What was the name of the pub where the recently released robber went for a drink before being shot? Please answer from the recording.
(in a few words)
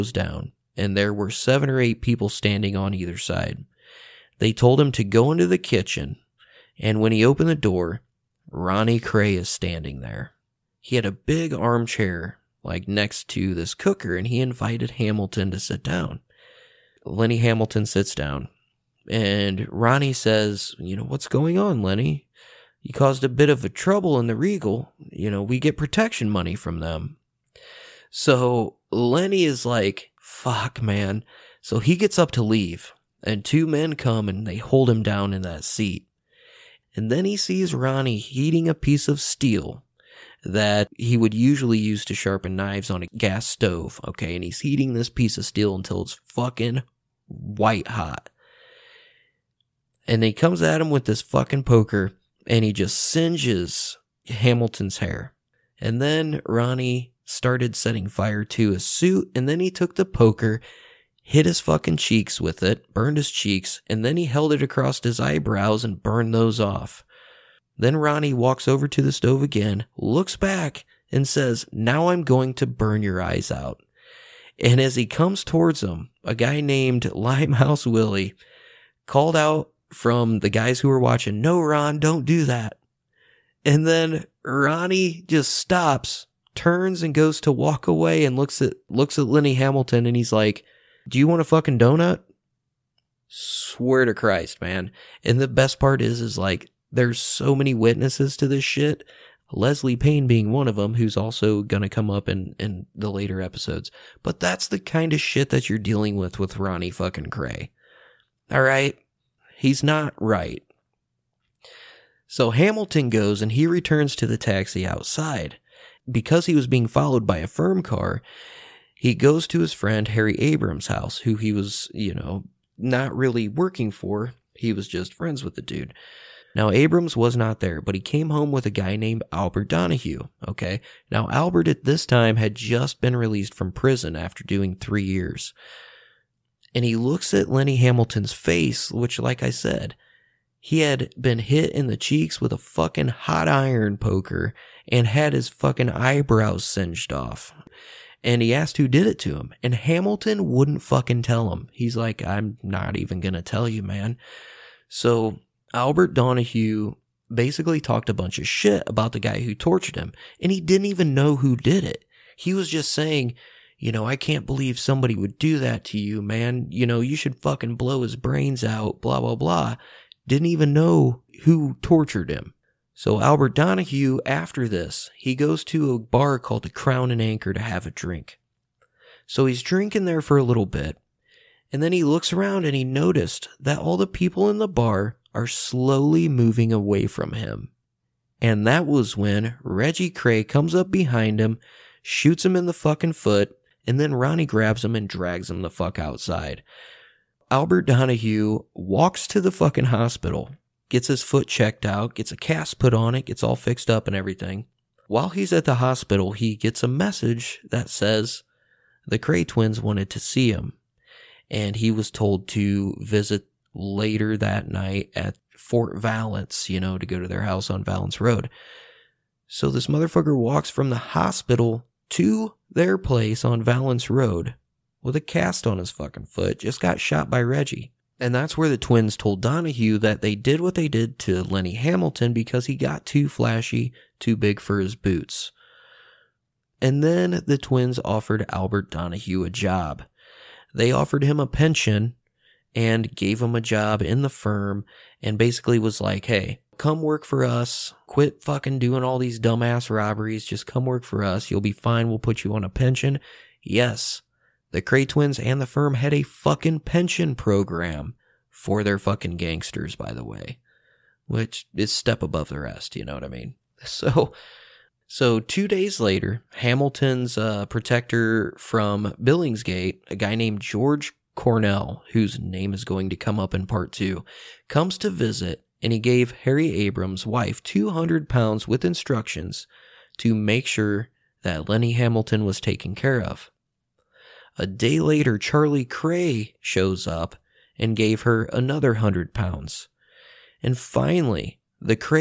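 Crown and Anchor.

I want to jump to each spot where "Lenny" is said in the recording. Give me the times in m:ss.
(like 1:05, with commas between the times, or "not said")
0:17, 0:21, 0:28, 1:29, 2:17, 3:51, 4:41.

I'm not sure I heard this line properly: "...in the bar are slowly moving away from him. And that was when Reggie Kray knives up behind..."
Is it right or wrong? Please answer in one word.
wrong.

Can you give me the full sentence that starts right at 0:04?
They told him to go into the kitchen, and when he opened the door, Ronnie Kray is standing there.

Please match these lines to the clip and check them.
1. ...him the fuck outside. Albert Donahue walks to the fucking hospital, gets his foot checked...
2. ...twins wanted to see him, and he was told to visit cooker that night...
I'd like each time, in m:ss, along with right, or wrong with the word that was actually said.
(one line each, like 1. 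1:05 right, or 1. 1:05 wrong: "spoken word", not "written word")
1. 3:15 right
2. 3:29 wrong: "later", not "cooker".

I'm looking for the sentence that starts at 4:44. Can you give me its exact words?
A day later, Charlie Kray shows up and gave her another 100 pounds.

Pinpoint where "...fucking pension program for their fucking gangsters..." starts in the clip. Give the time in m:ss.
4:16.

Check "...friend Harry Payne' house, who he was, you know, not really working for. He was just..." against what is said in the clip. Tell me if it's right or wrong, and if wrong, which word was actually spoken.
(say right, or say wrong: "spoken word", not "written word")
wrong: "Abrams", not "Payne".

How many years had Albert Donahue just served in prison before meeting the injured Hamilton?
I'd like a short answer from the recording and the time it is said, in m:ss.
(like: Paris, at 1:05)
3, at 2:14.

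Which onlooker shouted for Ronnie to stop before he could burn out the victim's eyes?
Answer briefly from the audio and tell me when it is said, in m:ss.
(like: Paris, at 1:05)
Limehouse Willie, at 1:17.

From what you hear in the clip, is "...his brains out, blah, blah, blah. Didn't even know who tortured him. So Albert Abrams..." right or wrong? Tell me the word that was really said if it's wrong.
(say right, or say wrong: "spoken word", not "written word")
wrong: "Donahue", not "Abrams".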